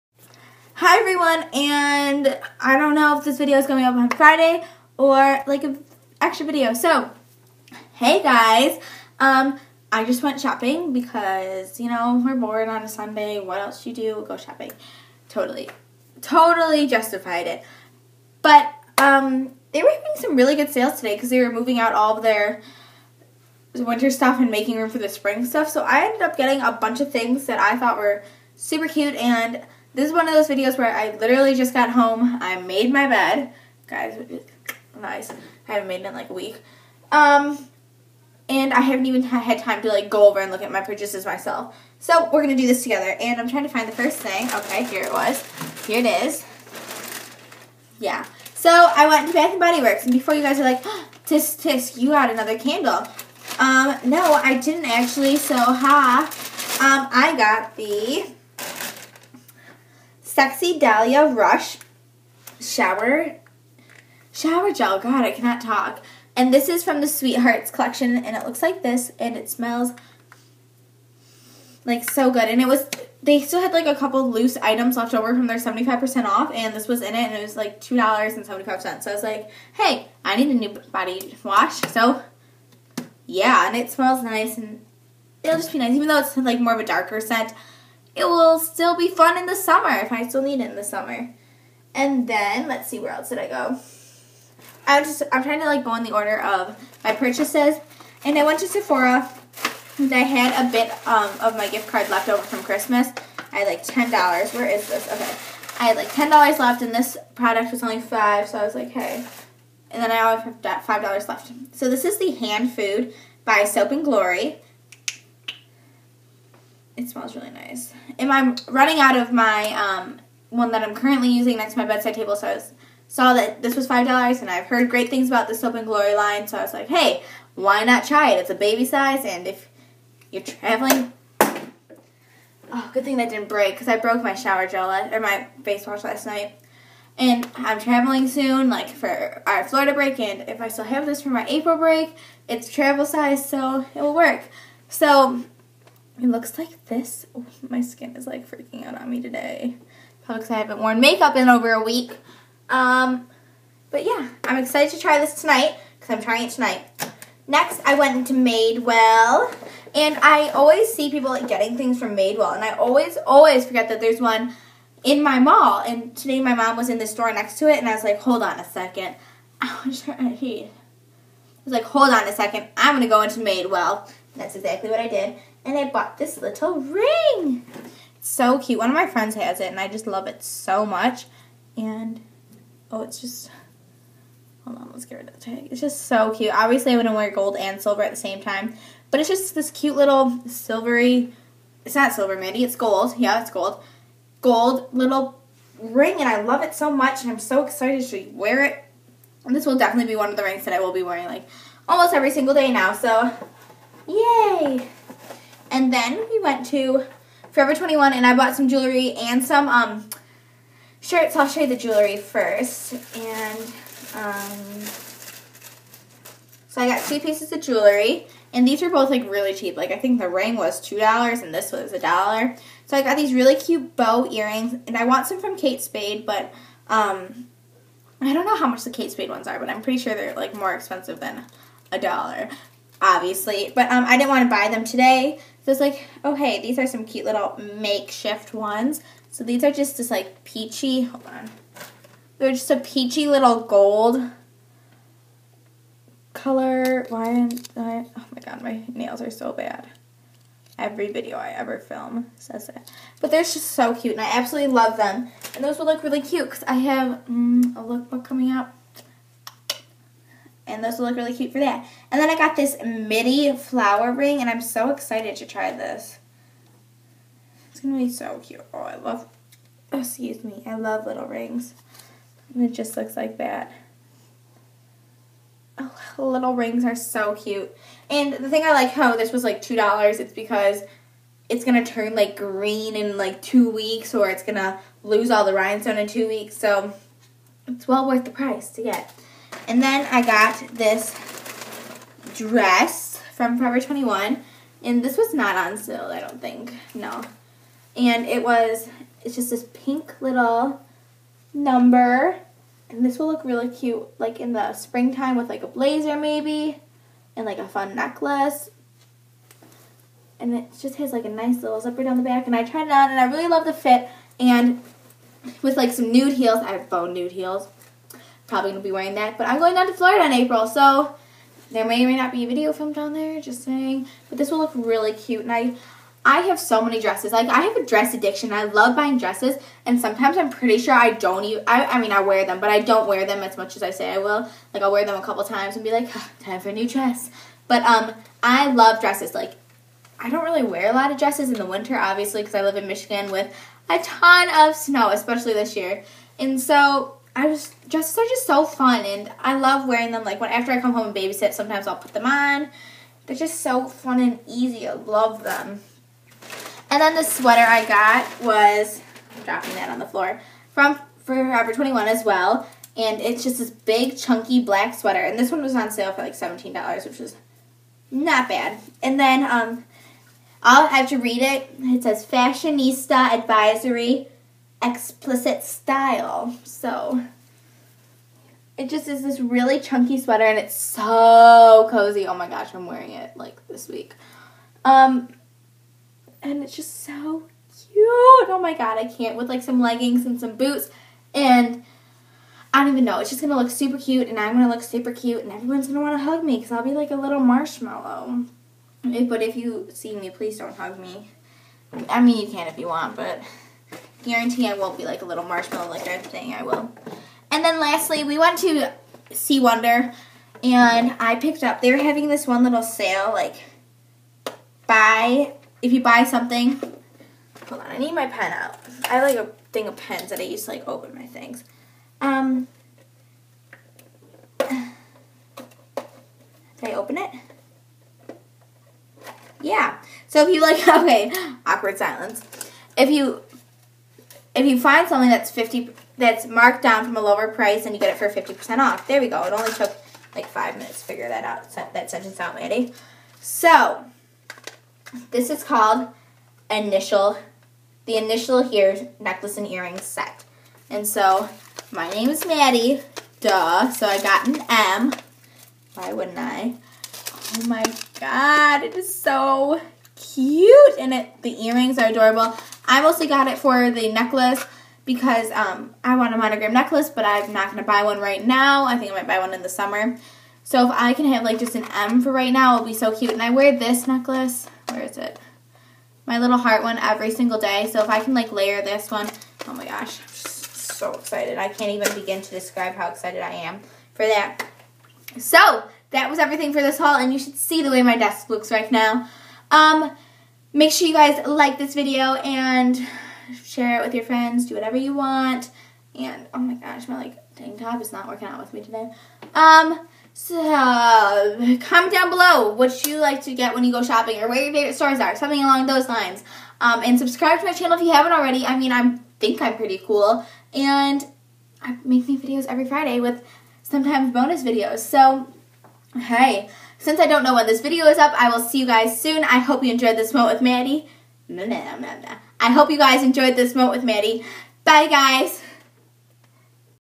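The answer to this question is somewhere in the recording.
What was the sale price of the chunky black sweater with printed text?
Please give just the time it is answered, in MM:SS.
06:06.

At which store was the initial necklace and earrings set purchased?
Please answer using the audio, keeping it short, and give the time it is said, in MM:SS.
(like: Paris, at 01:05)
C. Wonder, at 06:49.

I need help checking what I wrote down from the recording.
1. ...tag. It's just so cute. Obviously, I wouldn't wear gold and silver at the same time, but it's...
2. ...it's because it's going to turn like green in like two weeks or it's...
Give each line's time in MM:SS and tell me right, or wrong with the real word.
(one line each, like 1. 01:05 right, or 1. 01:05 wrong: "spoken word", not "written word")
1. 03:05 right
2. 04:40 right.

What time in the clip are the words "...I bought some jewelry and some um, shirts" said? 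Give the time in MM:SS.
03:28.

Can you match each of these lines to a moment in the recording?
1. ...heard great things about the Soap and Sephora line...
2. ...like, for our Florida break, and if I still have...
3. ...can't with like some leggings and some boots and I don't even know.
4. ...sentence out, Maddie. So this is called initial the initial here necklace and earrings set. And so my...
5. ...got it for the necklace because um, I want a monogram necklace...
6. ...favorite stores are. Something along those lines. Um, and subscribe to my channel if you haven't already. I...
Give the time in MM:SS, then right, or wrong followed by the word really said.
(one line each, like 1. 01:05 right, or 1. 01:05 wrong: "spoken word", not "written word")
1. 02:04 wrong: "Glory", not "Sephora"
2. 02:18 right
3. 06:29 right
4. 07:22 right
5. 07:43 right
6. 08:24 right.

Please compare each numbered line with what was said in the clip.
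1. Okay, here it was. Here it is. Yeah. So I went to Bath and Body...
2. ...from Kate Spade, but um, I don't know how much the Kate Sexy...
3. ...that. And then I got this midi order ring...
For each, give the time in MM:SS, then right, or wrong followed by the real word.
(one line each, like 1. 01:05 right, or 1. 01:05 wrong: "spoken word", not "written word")
1. 00:44 right
2. 03:45 wrong: "Spade", not "Sexy"
3. 04:21 wrong: "flower", not "order".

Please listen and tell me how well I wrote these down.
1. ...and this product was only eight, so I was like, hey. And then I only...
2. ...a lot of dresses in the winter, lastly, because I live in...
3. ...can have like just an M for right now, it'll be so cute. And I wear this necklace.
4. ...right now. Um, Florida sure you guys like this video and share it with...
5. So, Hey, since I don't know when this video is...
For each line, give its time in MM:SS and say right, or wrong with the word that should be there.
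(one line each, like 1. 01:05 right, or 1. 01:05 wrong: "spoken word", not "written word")
1. 01:46 wrong: "five", not "eight"
2. 05:40 wrong: "obviously", not "lastly"
3. 07:51 right
4. 08:08 wrong: "Make", not "Florida"
5. 08:34 right.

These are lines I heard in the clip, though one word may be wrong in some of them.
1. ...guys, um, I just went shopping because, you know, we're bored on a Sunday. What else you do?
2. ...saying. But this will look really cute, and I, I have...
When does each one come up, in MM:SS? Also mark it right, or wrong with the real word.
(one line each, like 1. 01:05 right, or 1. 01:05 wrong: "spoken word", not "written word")
1. 00:08 right
2. 05:23 right.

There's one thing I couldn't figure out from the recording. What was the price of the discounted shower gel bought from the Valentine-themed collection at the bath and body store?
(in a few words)
$2.75.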